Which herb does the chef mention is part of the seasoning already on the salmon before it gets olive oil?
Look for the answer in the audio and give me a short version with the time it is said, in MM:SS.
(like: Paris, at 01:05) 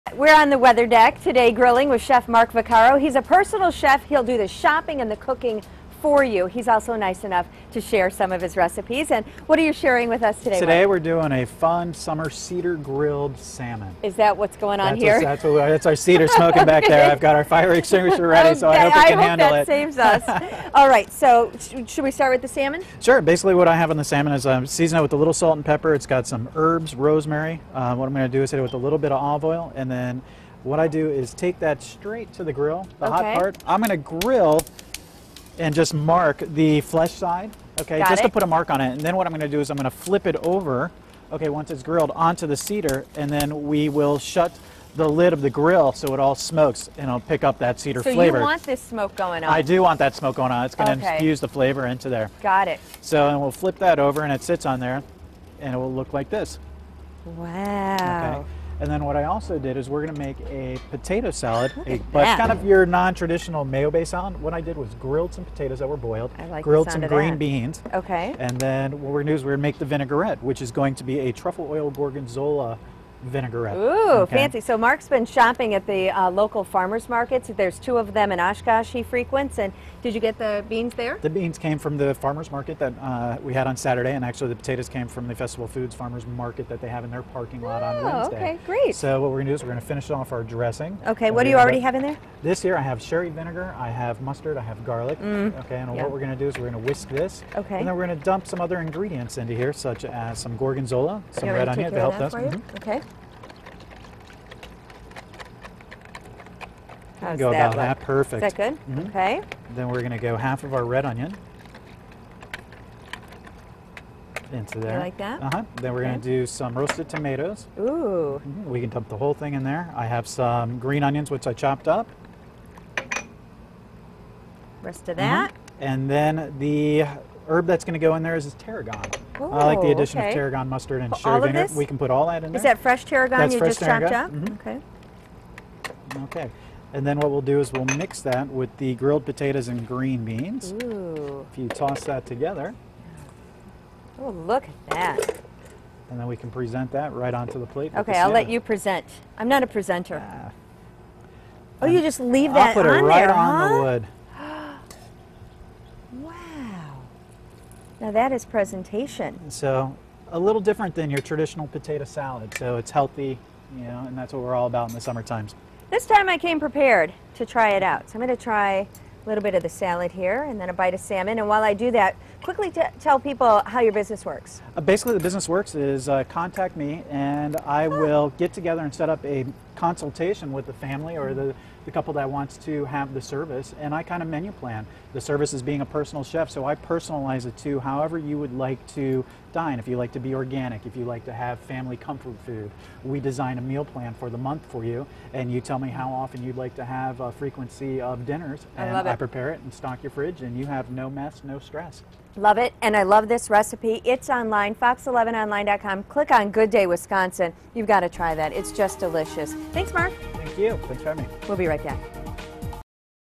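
Rosemary, at 00:26.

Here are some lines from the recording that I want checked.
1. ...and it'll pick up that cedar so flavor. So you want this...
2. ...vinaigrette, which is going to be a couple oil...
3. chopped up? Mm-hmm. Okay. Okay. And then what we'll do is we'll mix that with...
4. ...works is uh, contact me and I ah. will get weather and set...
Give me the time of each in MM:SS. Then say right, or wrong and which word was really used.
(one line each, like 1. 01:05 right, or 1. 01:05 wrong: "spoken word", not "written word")
1. 00:46 right
2. 01:09 wrong: "truffle", not "couple"
3. 02:14 right
4. 02:55 wrong: "together", not "weather".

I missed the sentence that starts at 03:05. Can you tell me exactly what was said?
The service is being a personal chef, so I personalize it to however you would like to dine.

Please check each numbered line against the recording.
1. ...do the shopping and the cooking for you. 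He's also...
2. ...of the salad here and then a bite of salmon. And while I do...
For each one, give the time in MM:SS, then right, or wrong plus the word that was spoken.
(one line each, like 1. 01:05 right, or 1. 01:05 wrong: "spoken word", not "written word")
1. 00:04 right
2. 02:49 right.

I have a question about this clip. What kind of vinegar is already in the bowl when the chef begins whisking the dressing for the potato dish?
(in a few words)
Sherry vinegar.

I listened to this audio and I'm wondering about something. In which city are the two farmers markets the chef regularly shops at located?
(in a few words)
Oshkosh.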